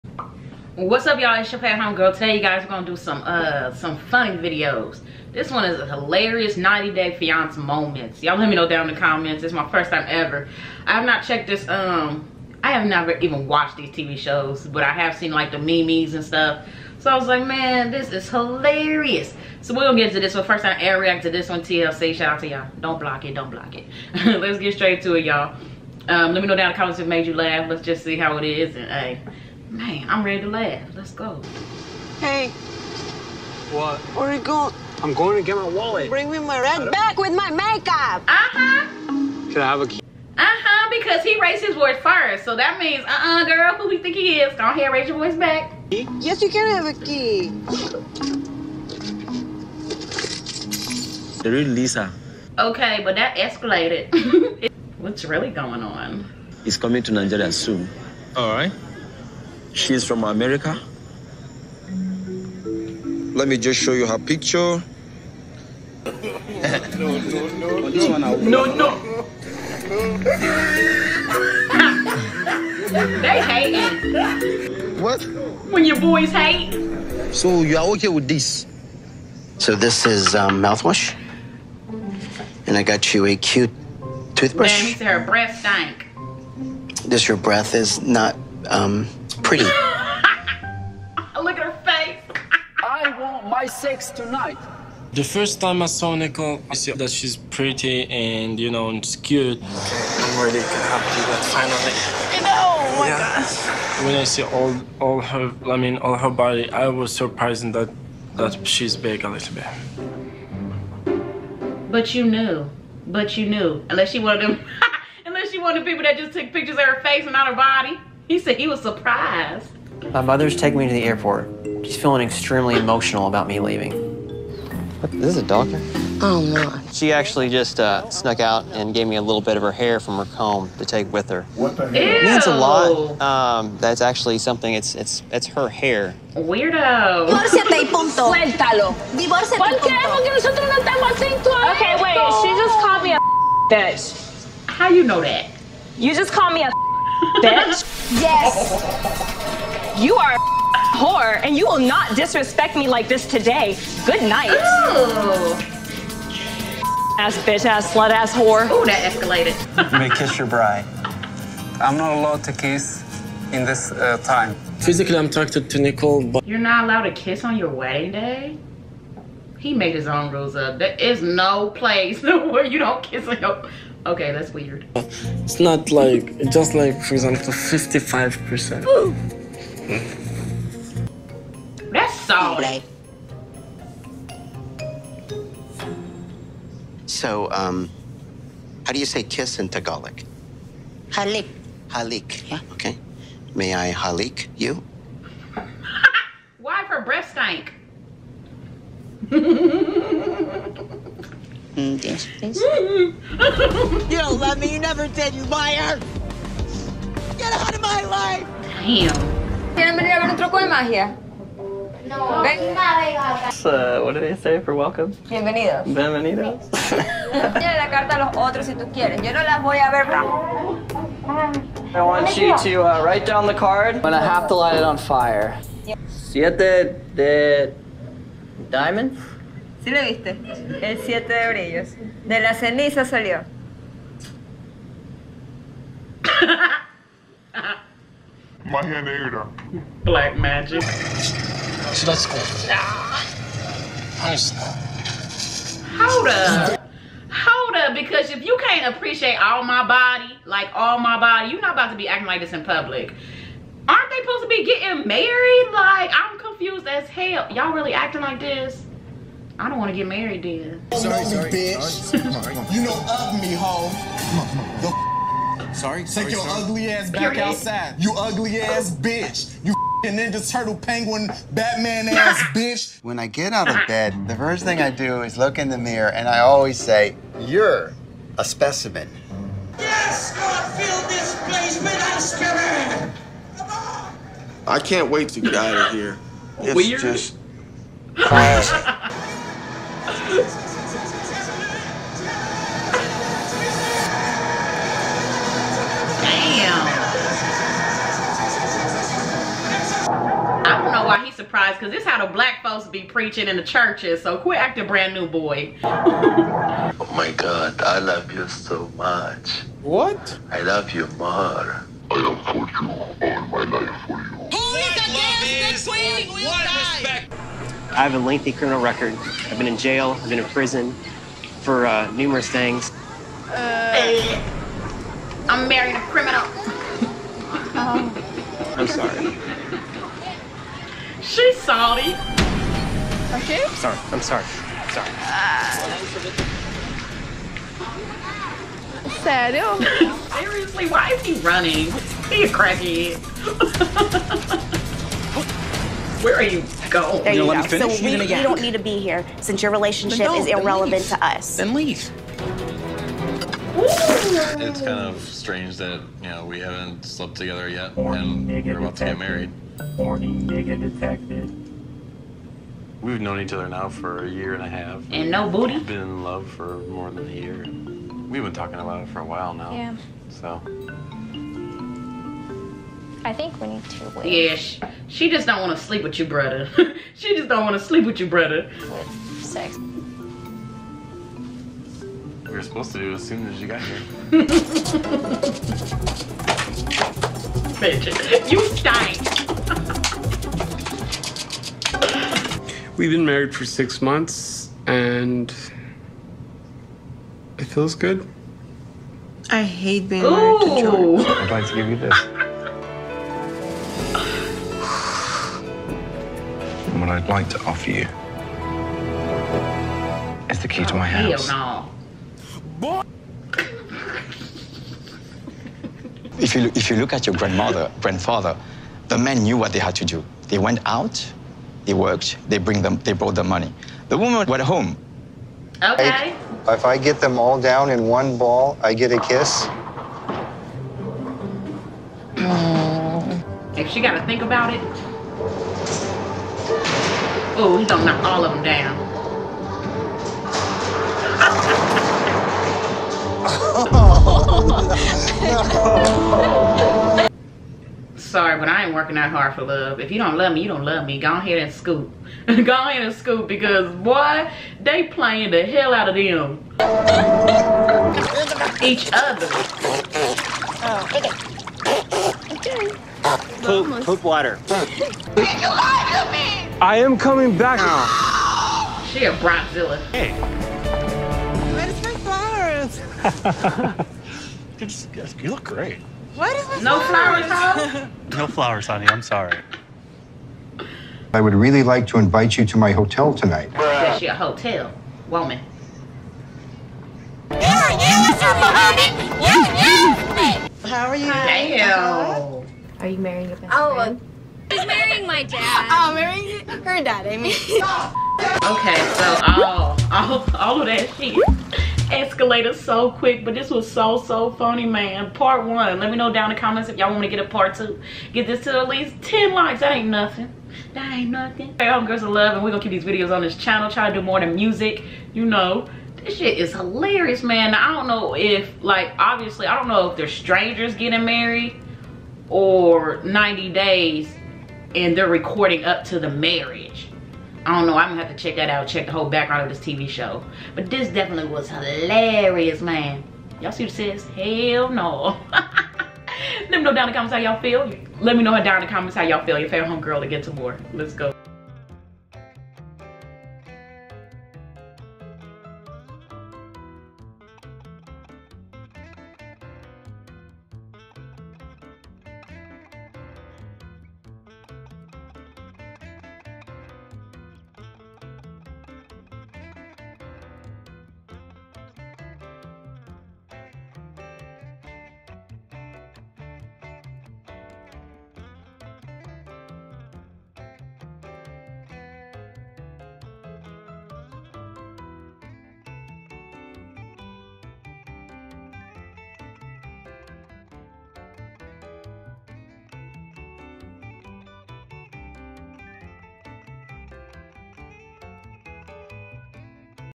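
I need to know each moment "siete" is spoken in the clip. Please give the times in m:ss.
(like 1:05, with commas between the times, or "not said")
3:46, 3:51.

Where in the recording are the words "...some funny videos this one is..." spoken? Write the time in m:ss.
0:03.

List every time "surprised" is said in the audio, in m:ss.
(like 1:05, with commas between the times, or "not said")
1:47, 1:58, 5:01.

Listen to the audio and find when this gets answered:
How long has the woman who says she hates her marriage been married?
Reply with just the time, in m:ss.
6:33.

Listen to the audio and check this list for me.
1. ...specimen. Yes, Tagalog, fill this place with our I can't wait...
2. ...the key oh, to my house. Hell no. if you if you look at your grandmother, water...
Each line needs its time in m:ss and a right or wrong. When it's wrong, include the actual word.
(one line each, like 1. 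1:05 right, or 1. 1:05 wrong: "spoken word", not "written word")
1. 4:38 wrong: "God", not "Tagalog"
2. 6:50 wrong: "grandfather", not "water".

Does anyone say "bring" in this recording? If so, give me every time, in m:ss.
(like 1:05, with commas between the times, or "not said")
0:36, 7:02.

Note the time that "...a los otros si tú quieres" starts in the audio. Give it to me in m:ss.
3:38.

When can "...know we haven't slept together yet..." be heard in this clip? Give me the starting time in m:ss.
5:56.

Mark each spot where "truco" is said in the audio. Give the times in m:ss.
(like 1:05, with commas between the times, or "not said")
3:30.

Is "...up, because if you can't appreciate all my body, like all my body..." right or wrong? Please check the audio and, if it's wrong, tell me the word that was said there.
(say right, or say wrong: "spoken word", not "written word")
right.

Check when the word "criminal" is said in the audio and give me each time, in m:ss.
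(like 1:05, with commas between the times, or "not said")
5:18, 5:26.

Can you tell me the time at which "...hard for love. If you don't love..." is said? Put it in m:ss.
7:29.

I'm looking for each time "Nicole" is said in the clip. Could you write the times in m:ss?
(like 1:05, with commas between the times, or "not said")
1:36, 2:45.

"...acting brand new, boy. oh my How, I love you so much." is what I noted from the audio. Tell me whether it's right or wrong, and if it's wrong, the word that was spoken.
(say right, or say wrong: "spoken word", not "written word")
wrong: "God", not "How".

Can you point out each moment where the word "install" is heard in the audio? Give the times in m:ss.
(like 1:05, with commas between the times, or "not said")
not said.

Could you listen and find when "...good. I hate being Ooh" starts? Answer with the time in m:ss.
6:37.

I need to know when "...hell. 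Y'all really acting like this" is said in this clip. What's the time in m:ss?
4:17.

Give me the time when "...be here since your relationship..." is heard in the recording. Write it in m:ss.
5:48.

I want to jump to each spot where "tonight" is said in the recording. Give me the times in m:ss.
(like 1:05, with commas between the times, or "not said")
1:34, 8:03.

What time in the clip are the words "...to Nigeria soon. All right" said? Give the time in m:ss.
0:57.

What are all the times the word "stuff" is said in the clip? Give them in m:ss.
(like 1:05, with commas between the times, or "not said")
0:16.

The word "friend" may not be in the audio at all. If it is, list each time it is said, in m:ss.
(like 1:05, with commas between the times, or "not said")
8:13.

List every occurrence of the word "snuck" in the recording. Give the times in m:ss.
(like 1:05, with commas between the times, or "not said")
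2:08.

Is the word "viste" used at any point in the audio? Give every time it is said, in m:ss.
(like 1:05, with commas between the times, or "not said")
3:50.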